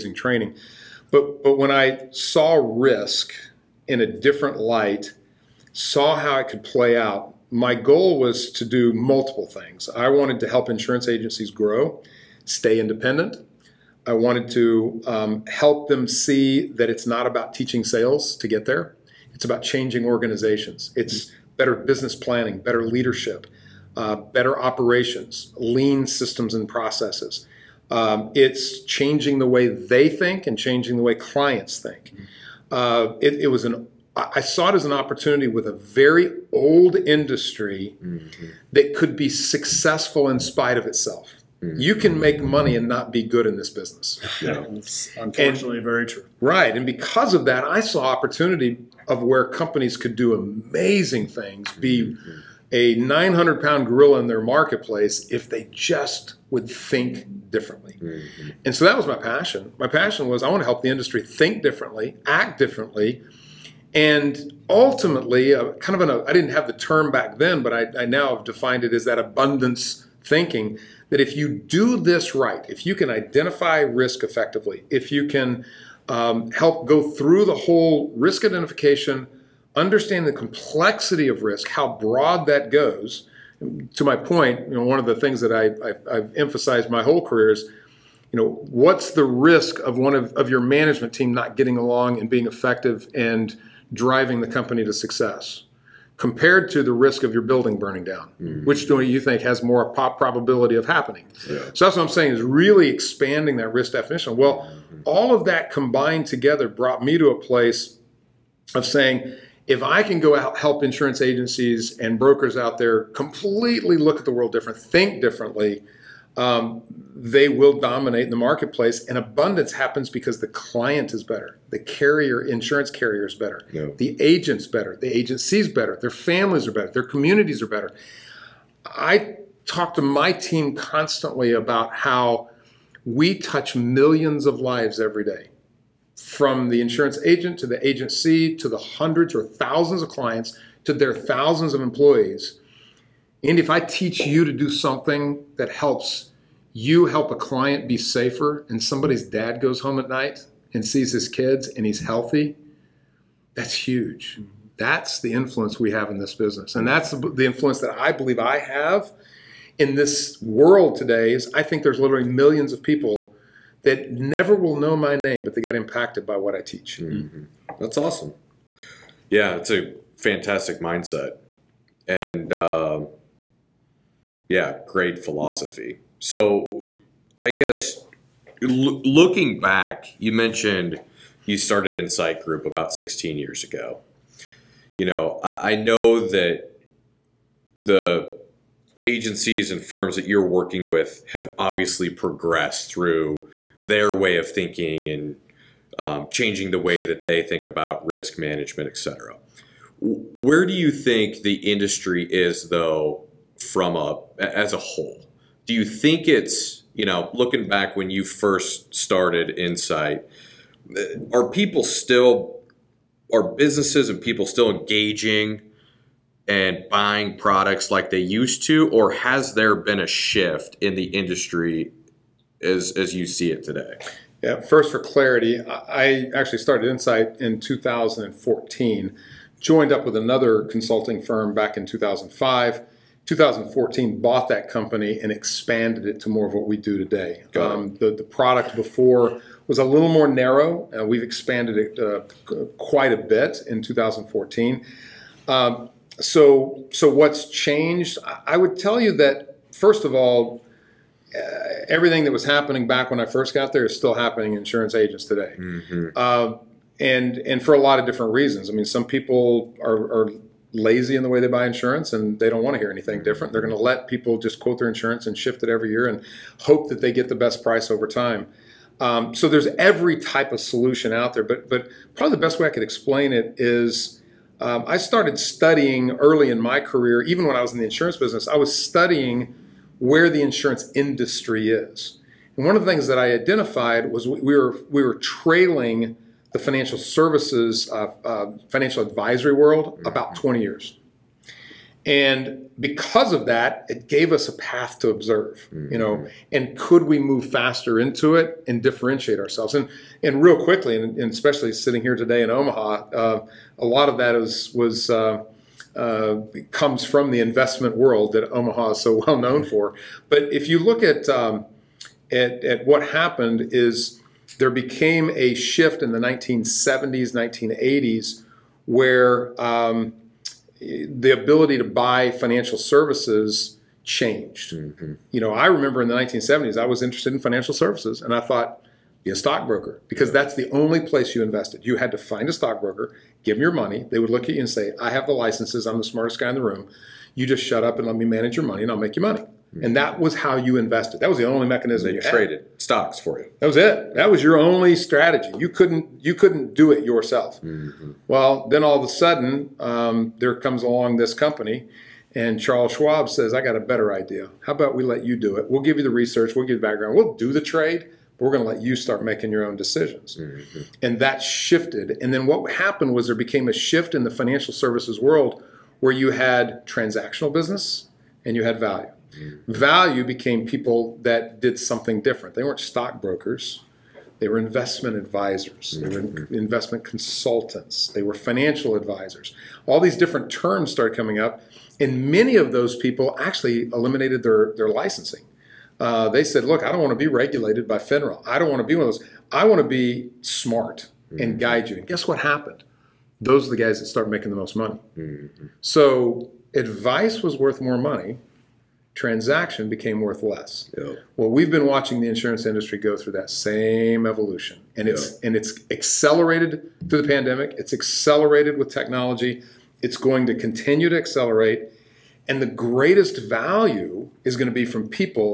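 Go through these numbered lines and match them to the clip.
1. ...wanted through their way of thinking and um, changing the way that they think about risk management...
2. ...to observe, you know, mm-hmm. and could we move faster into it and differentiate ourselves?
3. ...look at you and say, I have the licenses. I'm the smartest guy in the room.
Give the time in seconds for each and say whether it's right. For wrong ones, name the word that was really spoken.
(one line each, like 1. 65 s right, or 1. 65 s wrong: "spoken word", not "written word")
1. 192 s wrong: "progressed", not "wanted"
2. 294 s right
3. 334 s right.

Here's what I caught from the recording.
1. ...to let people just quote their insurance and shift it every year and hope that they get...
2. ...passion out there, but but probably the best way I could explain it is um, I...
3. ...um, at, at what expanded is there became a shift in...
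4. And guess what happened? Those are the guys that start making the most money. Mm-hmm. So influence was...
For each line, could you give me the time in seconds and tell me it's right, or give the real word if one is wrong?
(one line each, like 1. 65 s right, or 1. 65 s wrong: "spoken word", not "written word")
1. 263 s right
2. 270 s wrong: "solution", not "passion"
3. 311 s wrong: "happened", not "expanded"
4. 391 s wrong: "advice", not "influence".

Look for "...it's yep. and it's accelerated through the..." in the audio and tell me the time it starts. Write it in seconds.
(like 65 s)
405 s.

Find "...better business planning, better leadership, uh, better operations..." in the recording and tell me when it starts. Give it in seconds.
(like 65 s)
21 s.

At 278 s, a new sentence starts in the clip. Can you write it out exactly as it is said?
I was studying where the insurance industry is.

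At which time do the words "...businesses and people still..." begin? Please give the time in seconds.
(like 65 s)
213 s.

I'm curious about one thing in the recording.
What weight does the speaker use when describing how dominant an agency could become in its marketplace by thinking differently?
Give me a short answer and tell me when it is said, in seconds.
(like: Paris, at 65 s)
900 pound, at 52 s.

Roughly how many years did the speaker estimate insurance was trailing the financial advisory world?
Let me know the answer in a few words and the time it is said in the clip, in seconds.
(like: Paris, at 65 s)
20 years, at 290 s.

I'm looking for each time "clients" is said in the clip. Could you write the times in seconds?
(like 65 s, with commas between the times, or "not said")
31 s, 120 s, 140 s, 147 s.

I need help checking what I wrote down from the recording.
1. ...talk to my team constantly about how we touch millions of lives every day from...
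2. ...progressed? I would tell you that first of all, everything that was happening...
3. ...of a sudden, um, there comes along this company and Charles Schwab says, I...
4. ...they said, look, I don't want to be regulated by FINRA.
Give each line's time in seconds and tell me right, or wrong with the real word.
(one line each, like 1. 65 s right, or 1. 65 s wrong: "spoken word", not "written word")
1. 129 s right
2. 247 s wrong: "changed", not "progressed"
3. 348 s right
4. 386 s right.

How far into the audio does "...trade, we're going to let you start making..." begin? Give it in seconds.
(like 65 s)
357 s.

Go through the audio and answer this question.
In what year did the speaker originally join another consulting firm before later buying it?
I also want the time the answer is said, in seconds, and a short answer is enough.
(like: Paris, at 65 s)
2005, at 231 s.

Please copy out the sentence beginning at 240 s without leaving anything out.
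and we've expanded it uh, quite a bit in 2014.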